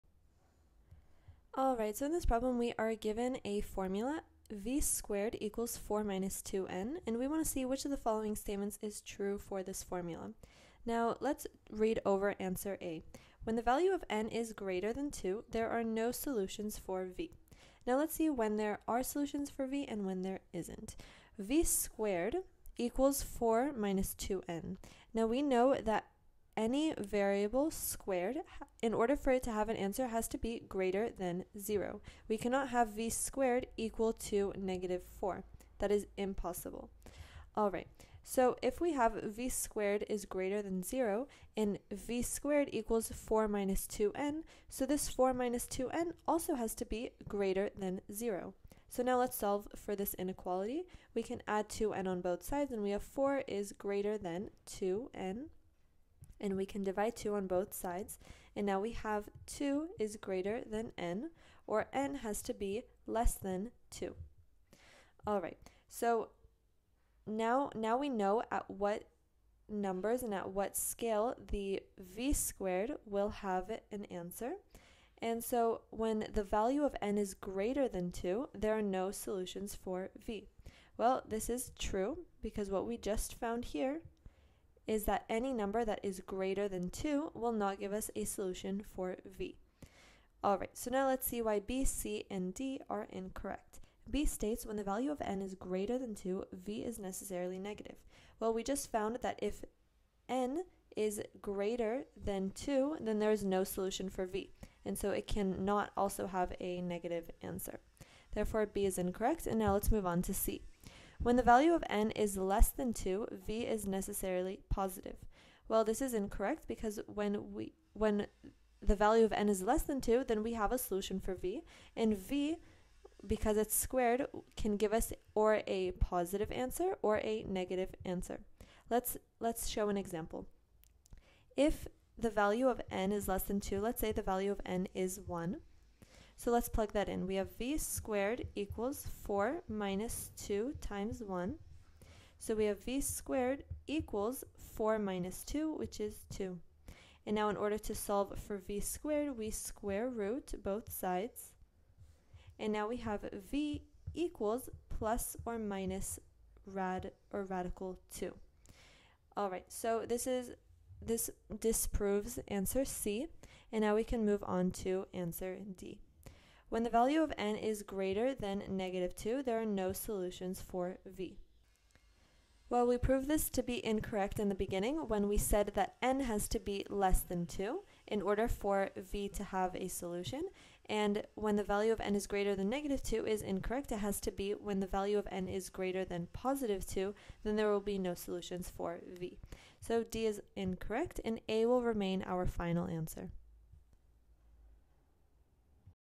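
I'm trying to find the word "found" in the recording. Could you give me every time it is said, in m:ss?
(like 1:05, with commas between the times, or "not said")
1:23, 1:38.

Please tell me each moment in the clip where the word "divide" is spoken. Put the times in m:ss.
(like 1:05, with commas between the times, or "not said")
0:56.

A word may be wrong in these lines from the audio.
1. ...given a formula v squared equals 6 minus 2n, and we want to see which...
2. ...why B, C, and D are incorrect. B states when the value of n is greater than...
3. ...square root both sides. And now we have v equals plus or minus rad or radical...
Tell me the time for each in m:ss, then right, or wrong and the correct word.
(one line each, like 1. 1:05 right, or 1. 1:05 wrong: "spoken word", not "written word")
1. 0:02 wrong: "4", not "6"
2. 1:31 right
3. 2:29 right.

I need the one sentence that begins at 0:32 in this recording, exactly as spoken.
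We cannot have v squared equal to negative 4.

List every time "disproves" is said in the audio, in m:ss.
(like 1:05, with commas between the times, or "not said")
2:41.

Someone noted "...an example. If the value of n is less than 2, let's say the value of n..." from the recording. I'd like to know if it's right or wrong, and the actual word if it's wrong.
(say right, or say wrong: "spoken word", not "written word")
right.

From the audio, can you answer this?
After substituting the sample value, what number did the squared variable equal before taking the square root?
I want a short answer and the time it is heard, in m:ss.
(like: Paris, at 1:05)
2, at 2:25.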